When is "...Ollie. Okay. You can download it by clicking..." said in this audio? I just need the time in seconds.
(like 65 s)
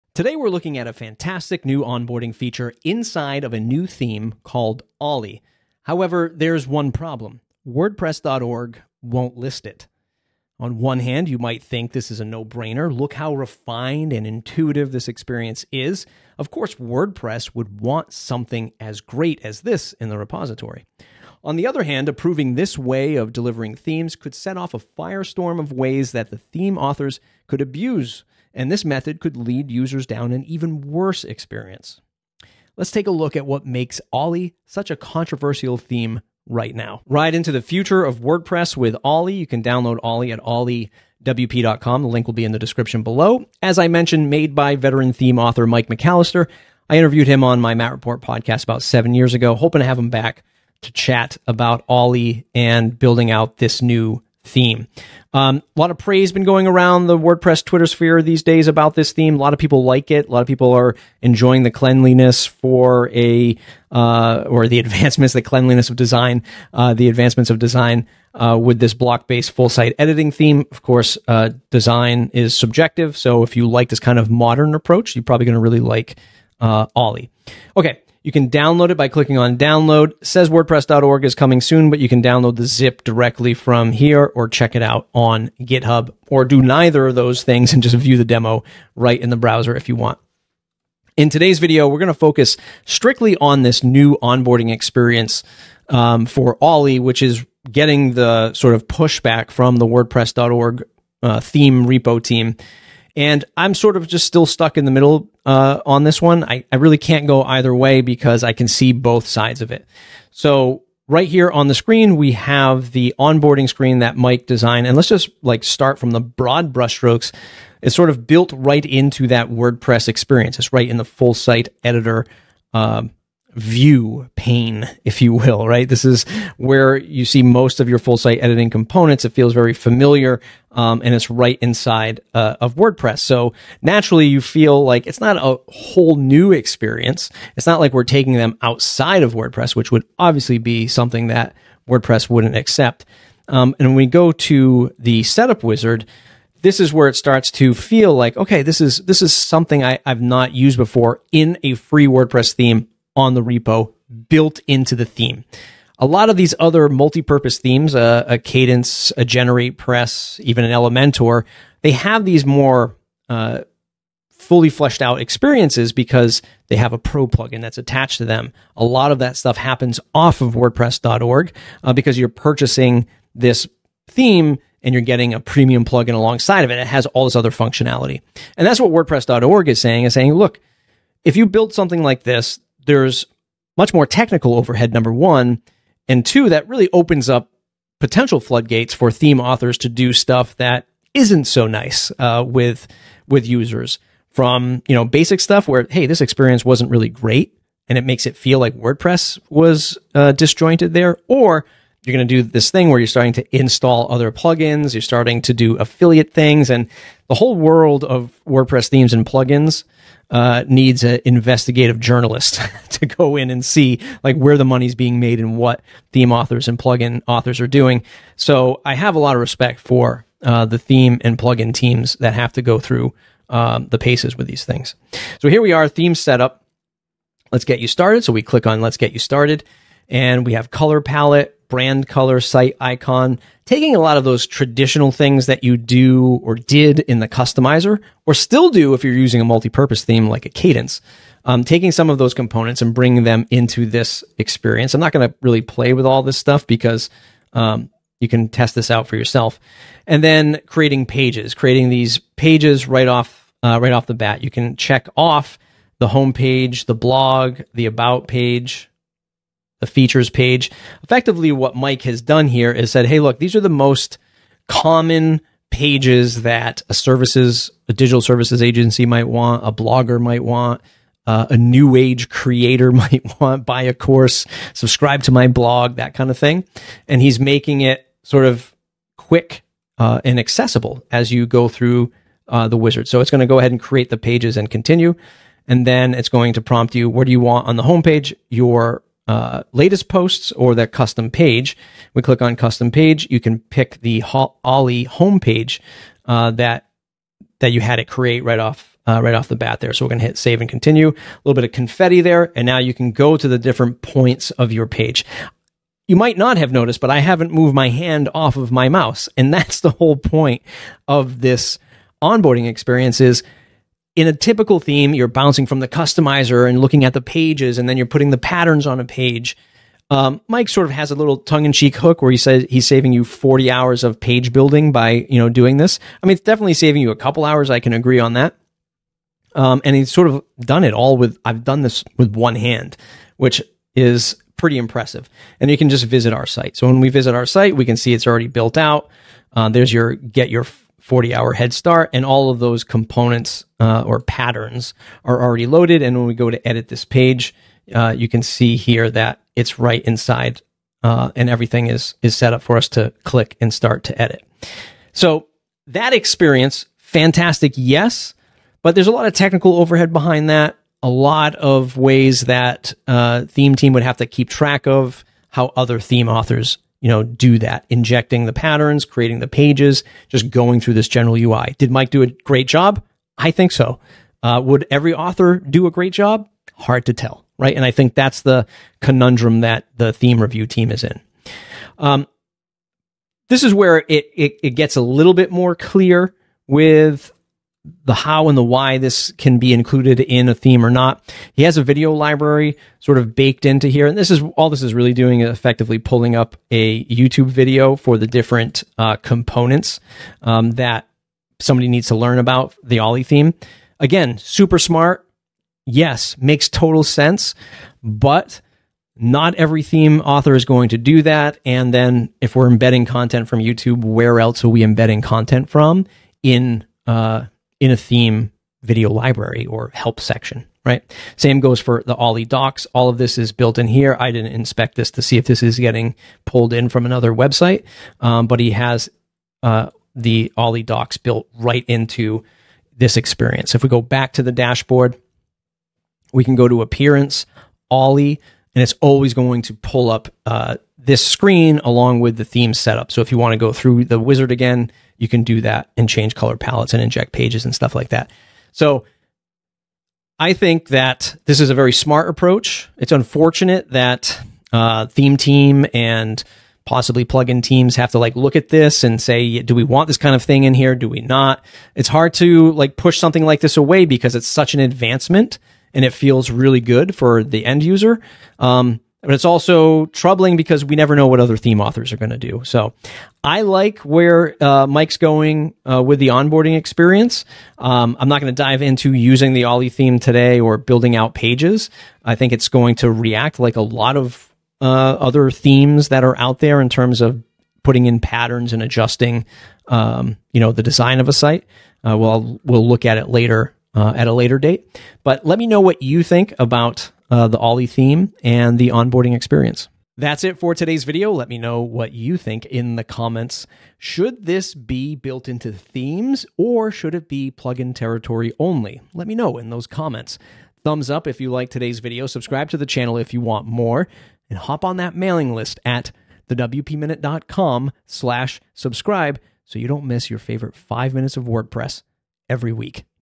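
76 s.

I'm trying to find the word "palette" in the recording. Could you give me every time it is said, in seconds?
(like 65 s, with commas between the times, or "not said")
231 s, 446 s.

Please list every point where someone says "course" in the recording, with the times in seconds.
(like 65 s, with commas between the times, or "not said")
16 s, 70 s, 273 s.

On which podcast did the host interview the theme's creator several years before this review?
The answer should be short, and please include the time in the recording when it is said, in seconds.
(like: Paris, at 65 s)
Matt Report, at 47 s.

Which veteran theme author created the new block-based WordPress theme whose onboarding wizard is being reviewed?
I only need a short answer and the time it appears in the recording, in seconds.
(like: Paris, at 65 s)
Mike McCalister, at 45 s.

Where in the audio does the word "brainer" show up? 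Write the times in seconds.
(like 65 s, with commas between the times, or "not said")
12 s.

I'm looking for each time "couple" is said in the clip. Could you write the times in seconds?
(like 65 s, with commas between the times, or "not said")
327 s.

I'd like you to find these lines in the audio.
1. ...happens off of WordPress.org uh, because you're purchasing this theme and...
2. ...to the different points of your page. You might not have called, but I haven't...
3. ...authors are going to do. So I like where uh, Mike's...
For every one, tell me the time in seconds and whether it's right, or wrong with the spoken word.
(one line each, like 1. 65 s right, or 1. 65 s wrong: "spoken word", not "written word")
1. 169 s right
2. 303 s wrong: "noticed", not "called"
3. 471 s right.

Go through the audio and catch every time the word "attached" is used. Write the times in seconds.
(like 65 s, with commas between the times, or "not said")
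167 s.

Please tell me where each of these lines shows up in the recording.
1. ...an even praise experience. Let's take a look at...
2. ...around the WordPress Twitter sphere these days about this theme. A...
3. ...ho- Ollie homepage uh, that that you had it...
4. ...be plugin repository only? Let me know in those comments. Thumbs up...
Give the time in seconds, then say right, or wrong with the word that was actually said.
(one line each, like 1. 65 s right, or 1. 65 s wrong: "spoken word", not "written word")
1. 30 s wrong: "worse", not "praise"
2. 56 s right
3. 294 s right
4. 507 s wrong: "territory", not "repository".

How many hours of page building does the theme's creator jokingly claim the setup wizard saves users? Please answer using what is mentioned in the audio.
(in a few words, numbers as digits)
40.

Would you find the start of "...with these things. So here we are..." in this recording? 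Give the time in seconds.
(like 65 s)
224 s.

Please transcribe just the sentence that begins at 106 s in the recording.
I, I really can't go either way because I can see both sides of it.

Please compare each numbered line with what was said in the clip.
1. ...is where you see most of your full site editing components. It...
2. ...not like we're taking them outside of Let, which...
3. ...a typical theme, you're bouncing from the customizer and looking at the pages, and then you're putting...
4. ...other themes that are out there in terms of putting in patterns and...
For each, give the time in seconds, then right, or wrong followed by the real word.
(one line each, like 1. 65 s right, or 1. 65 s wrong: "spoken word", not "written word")
1. 126 s right
2. 137 s wrong: "WordPress", not "Let"
3. 314 s right
4. 484 s right.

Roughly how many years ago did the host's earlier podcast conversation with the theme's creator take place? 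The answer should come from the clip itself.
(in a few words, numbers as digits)
7.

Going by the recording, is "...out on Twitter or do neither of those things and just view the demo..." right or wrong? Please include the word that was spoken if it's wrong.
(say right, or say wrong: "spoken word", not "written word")
wrong: "GitHub", not "Twitter".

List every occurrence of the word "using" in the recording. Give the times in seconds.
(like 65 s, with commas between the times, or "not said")
239 s, 479 s.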